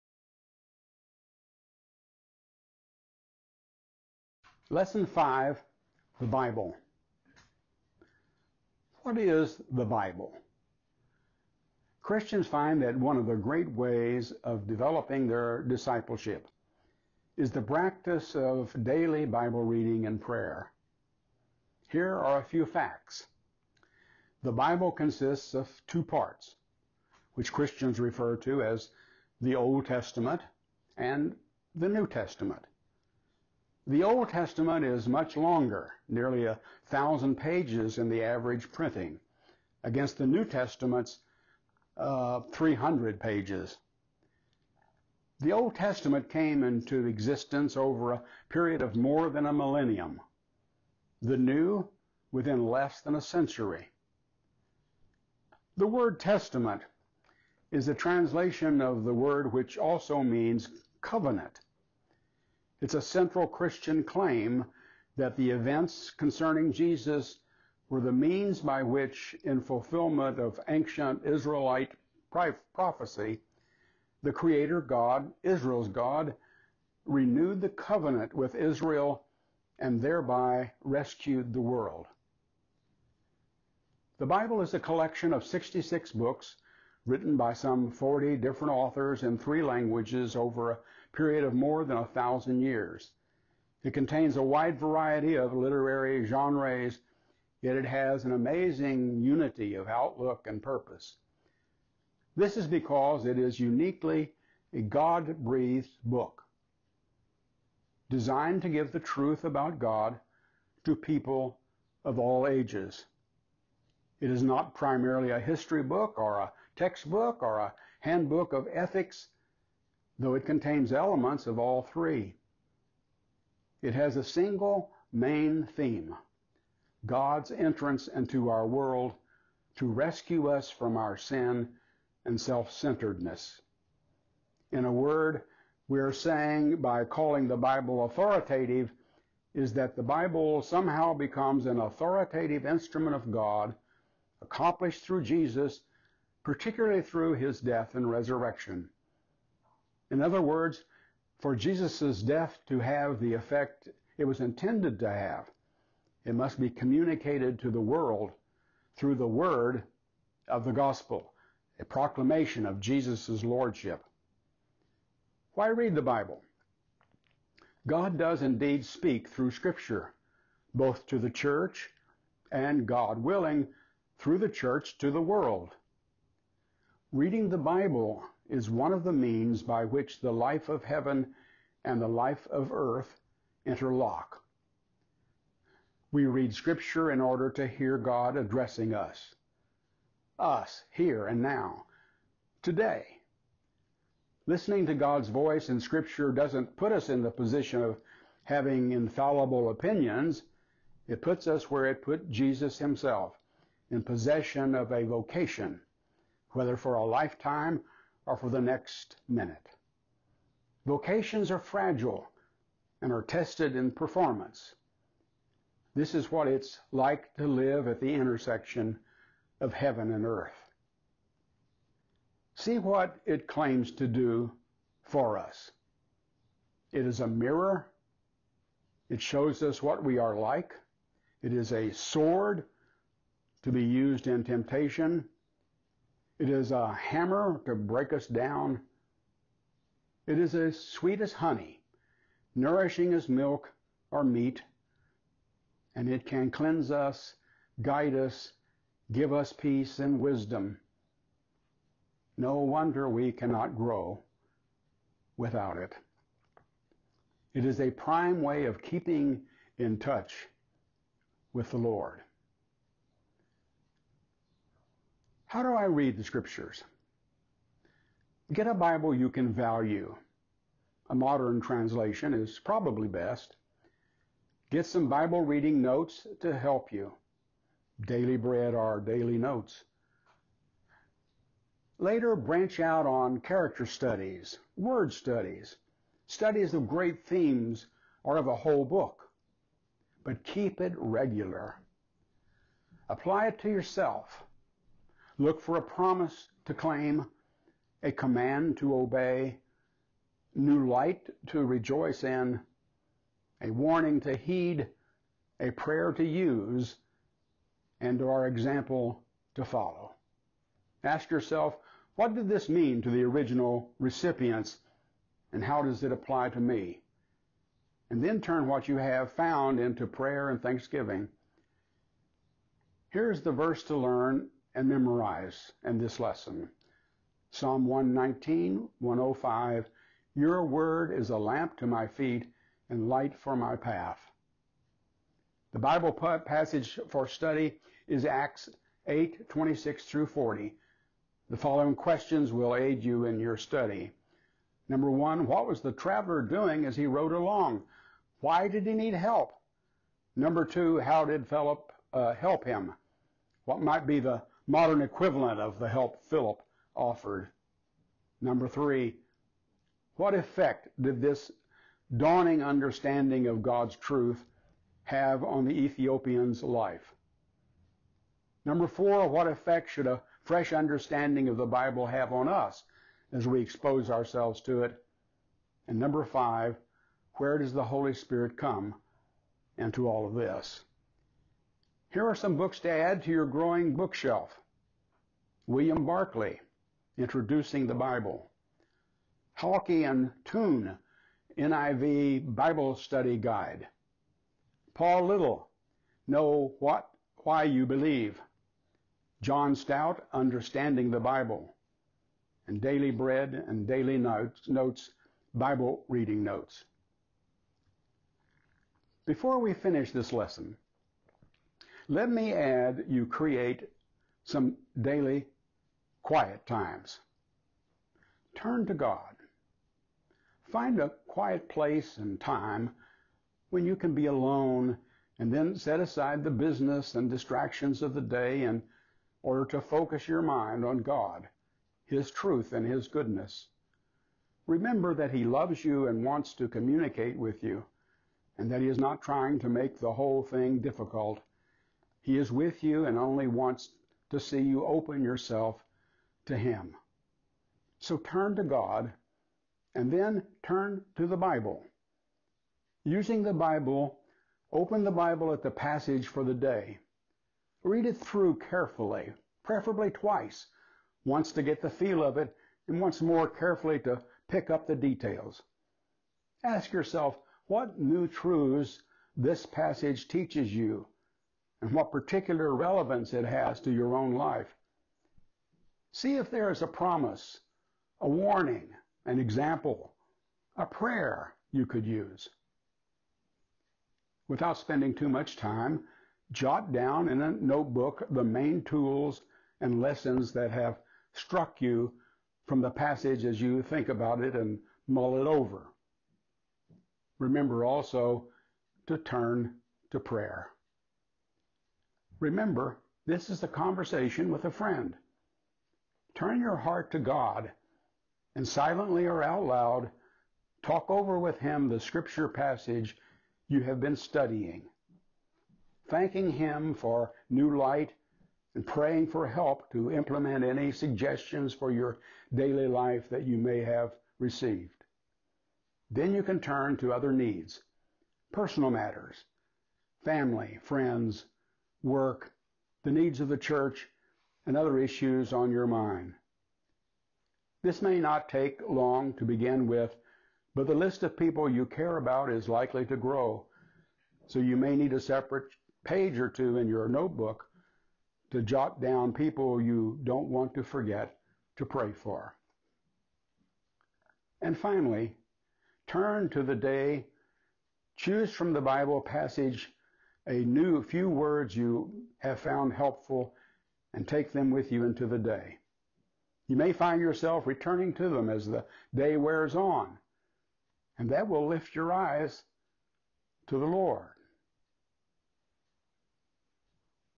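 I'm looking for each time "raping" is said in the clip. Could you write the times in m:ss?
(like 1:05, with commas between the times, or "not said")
not said.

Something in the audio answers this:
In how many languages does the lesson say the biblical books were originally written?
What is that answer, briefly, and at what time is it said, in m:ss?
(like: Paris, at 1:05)
3, at 1:29.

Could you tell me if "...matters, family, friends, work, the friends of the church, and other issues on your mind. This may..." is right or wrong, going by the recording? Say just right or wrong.
wrong.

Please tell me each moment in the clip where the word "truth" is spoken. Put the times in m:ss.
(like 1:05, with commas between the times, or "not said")
1:48, 6:03, 7:12, 7:48.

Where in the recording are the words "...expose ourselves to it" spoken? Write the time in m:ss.
6:13.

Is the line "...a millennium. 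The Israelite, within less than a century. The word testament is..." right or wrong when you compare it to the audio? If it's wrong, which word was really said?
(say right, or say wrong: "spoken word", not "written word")
wrong: "New", not "Israelite".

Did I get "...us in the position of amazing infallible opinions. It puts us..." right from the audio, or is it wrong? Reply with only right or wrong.
wrong.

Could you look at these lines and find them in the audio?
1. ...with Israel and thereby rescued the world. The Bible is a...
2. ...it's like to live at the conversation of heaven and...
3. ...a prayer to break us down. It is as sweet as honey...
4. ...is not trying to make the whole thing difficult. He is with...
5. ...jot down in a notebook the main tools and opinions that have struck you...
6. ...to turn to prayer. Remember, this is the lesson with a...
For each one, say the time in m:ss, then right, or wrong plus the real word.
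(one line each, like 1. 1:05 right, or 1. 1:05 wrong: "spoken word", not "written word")
1. 1:18 right
2. 3:36 wrong: "intersection", not "conversation"
3. 3:56 wrong: "hammer", not "prayer"
4. 7:18 right
5. 8:06 wrong: "lessons", not "opinions"
6. 8:19 wrong: "conversation", not "lesson".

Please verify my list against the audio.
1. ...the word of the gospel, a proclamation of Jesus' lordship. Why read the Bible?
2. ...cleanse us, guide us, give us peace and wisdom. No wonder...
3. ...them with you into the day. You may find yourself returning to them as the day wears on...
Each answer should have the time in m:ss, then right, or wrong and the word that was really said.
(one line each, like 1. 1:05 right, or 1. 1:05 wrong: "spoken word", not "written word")
1. 2:39 right
2. 4:06 right
3. 9:24 right.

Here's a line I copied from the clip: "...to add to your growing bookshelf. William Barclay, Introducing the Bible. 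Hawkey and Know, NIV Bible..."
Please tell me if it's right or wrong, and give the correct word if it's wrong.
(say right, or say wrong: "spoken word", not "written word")
wrong: "Toon", not "Know".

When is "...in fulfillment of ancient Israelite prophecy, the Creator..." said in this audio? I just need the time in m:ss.
1:09.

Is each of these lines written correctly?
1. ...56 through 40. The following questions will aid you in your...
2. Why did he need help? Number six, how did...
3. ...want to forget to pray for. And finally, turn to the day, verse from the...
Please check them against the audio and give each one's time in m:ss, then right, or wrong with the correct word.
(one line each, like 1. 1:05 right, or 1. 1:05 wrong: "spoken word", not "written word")
1. 5:39 wrong: "26", not "56"
2. 5:48 wrong: "two", not "six"
3. 9:10 wrong: "choose", not "verse".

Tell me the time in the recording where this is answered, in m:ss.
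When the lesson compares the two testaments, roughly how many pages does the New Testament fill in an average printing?
0:42.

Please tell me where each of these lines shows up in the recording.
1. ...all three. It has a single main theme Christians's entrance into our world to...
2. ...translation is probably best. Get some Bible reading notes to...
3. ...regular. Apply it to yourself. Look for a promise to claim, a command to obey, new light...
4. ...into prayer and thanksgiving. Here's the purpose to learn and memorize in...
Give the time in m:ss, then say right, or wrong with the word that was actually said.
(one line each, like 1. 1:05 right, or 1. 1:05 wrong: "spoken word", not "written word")
1. 2:01 wrong: "God", not "Christians"
2. 4:31 right
3. 4:50 right
4. 5:19 wrong: "verse", not "purpose".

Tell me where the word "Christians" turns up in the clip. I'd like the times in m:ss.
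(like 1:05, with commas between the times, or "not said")
0:12, 0:27, 1:03.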